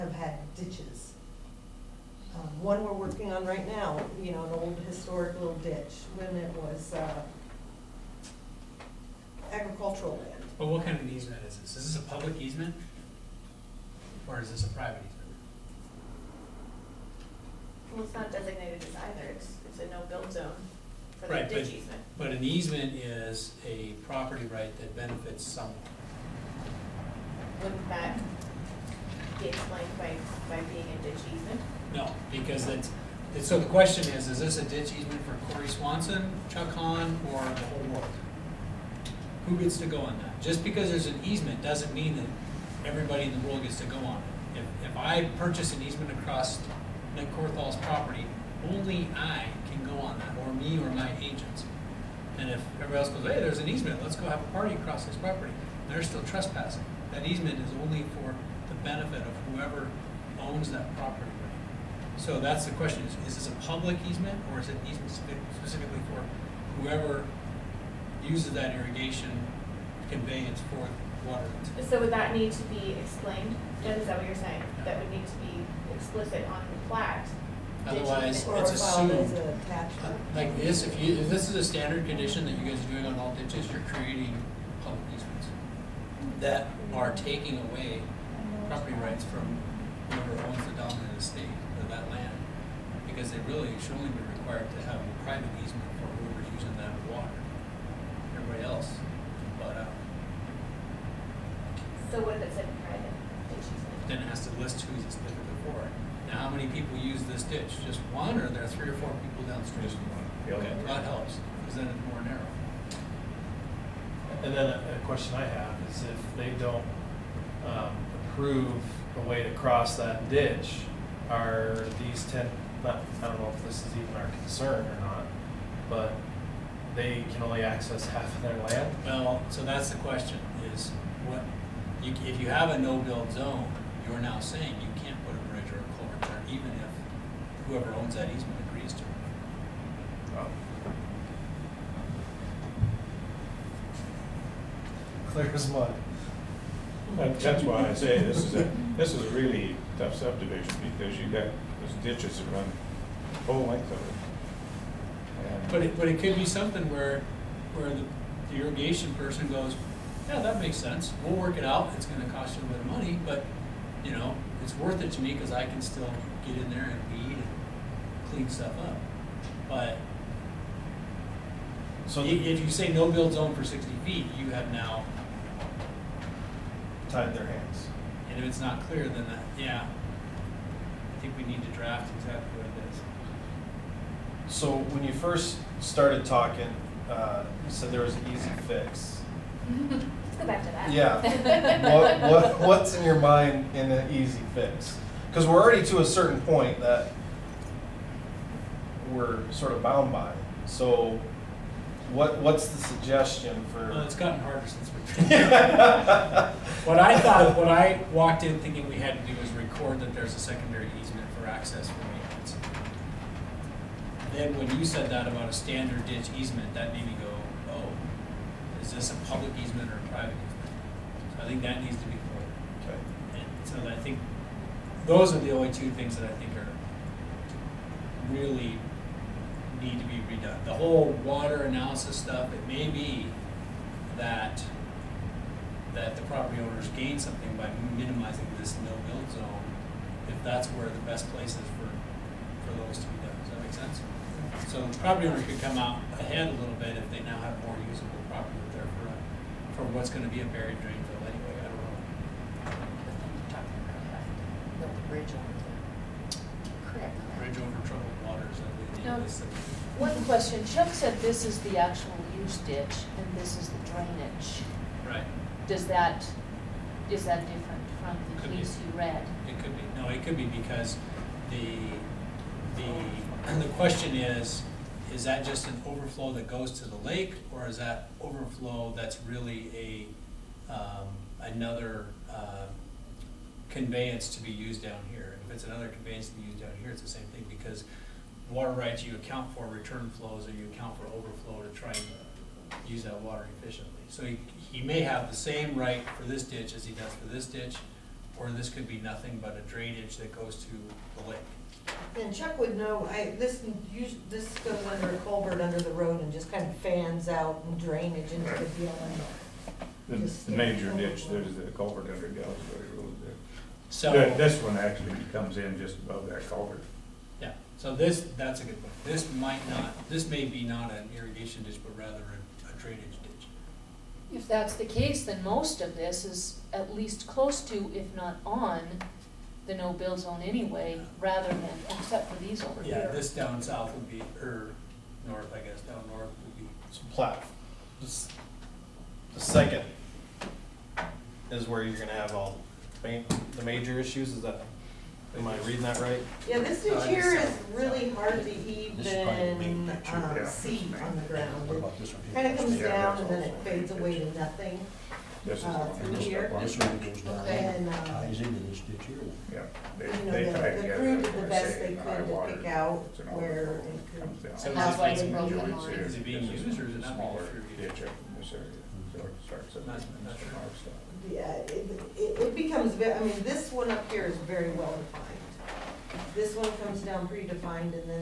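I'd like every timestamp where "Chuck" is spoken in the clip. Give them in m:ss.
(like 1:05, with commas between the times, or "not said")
0:36, 4:20, 5:02.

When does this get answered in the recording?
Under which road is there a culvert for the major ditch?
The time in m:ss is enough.
5:12.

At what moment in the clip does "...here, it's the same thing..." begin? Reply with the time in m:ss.
4:46.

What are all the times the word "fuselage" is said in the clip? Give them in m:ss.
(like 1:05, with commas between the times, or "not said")
not said.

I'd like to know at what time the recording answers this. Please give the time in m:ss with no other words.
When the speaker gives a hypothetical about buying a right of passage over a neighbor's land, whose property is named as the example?
0:47.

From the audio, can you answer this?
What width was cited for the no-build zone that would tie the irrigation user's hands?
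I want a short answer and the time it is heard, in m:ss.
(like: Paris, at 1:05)
60 feet, at 2:53.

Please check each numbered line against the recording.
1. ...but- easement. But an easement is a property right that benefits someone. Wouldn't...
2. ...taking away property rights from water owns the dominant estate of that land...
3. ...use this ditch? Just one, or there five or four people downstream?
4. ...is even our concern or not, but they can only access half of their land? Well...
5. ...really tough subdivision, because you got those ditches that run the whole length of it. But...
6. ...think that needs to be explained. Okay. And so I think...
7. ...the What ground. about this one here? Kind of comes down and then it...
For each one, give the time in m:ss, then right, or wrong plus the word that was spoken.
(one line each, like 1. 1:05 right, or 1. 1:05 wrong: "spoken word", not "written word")
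1. 0:21 right
2. 1:27 wrong: "whoever", not "water"
3. 1:46 wrong: "three", not "five"
4. 2:03 right
5. 2:29 right
6. 3:41 wrong: "recorded", not "explained"
7. 5:51 right.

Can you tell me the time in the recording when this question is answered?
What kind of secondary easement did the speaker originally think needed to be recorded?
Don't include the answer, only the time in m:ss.
3:31.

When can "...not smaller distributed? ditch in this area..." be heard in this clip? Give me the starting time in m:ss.
6:07.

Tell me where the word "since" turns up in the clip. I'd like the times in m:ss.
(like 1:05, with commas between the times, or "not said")
3:24.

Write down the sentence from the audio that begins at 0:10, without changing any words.
But what kind of easement is this?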